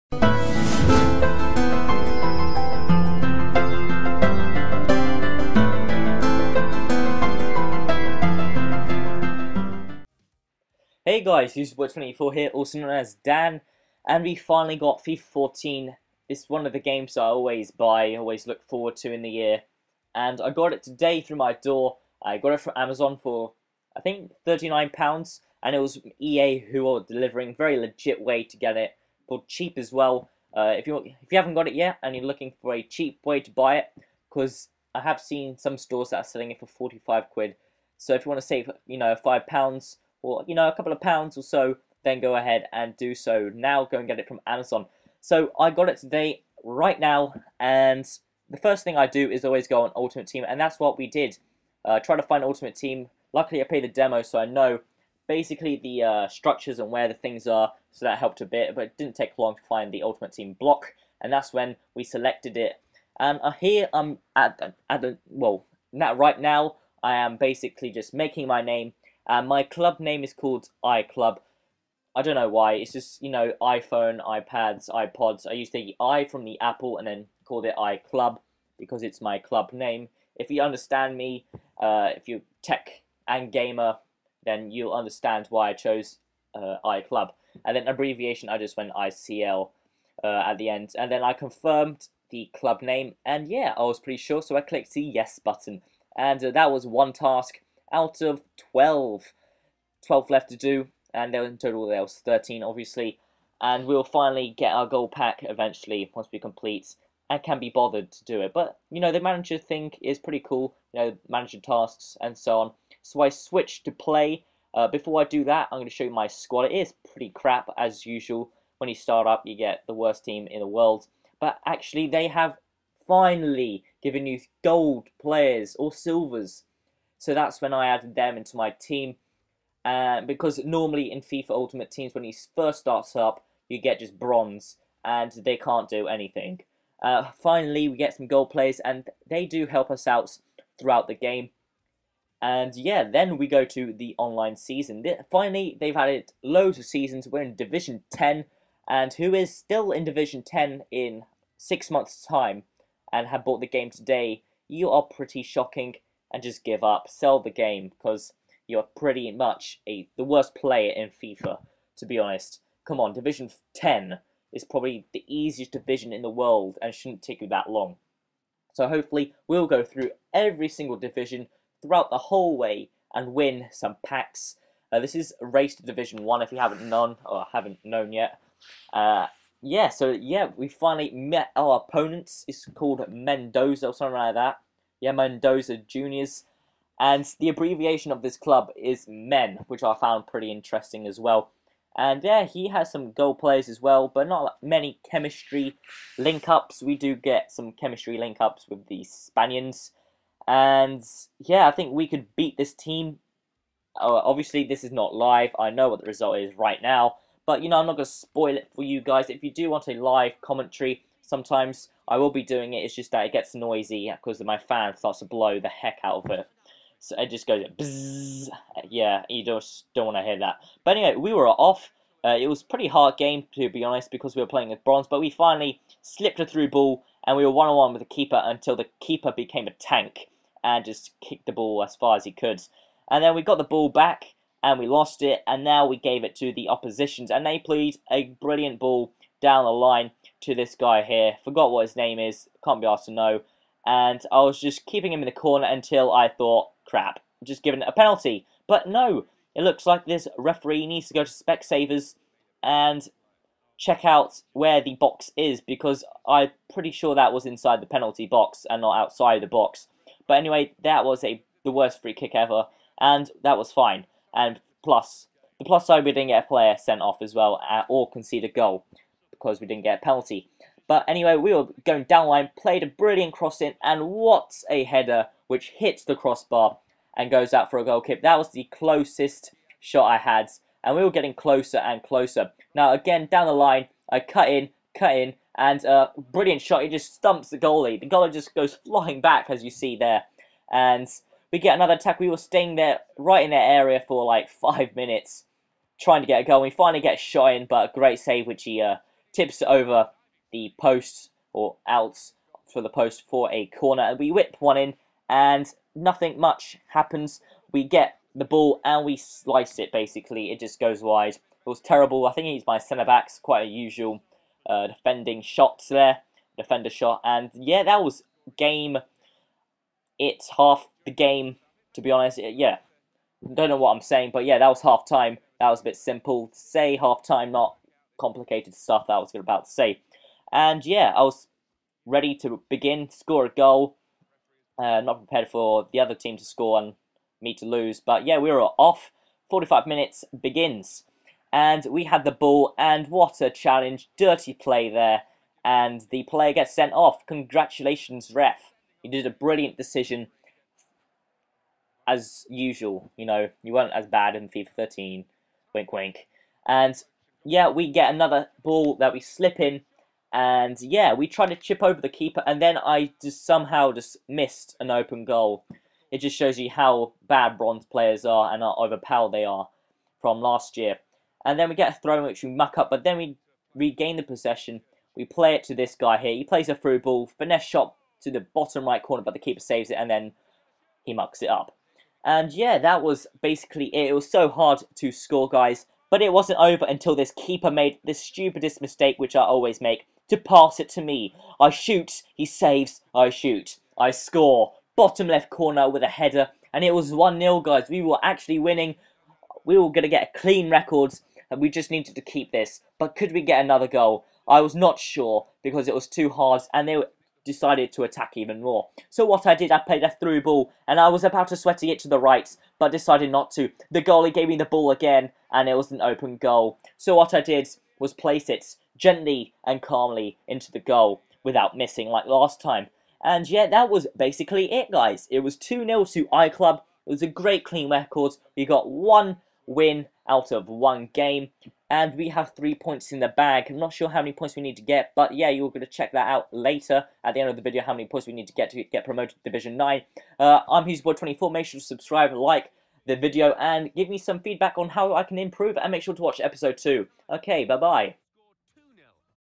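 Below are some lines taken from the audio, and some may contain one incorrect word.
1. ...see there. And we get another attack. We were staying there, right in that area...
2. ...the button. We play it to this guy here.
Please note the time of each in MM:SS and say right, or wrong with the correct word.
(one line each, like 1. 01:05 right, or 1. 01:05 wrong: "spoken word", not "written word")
1. 04:49 right
2. 06:14 wrong: "possession", not "button".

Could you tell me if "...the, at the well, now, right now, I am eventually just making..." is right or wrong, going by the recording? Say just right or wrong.
wrong.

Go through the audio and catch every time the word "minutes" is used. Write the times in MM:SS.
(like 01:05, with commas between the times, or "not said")
04:54, 05:39.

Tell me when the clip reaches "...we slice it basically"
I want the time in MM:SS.
05:09.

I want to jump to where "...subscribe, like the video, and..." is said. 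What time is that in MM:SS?
07:21.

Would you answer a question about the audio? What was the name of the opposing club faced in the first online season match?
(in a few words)
Mendoza Juniors.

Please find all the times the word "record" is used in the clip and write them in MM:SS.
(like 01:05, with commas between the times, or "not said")
06:40, 07:07.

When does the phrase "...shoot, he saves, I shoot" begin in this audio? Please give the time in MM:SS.
06:31.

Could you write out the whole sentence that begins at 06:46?
And they were decided to attack even more.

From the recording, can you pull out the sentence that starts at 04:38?
That was the closest shot I had, and we were getting closer and closer.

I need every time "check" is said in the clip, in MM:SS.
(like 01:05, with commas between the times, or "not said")
04:13, 07:15.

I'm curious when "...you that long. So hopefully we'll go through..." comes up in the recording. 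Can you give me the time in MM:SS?
02:47.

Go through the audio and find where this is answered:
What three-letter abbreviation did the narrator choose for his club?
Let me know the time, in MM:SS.
01:28.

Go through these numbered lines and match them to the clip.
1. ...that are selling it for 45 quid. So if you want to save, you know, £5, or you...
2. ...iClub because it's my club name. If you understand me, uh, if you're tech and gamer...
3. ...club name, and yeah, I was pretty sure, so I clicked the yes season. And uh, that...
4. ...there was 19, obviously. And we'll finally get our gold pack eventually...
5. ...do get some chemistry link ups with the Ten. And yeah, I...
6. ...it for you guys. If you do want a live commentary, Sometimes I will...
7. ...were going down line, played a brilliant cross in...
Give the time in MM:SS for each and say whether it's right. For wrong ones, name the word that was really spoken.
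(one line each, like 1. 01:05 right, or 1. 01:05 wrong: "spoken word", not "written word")
1. 00:36 right
2. 01:17 right
3. 01:32 wrong: "button", not "season"
4. 01:41 wrong: "13", not "19"
5. 03:16 wrong: "Spaniards", not "Ten"
6. 03:28 right
7. 04:31 right.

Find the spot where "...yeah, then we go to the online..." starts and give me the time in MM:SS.
02:22.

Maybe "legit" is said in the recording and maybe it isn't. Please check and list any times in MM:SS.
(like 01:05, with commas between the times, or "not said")
00:27.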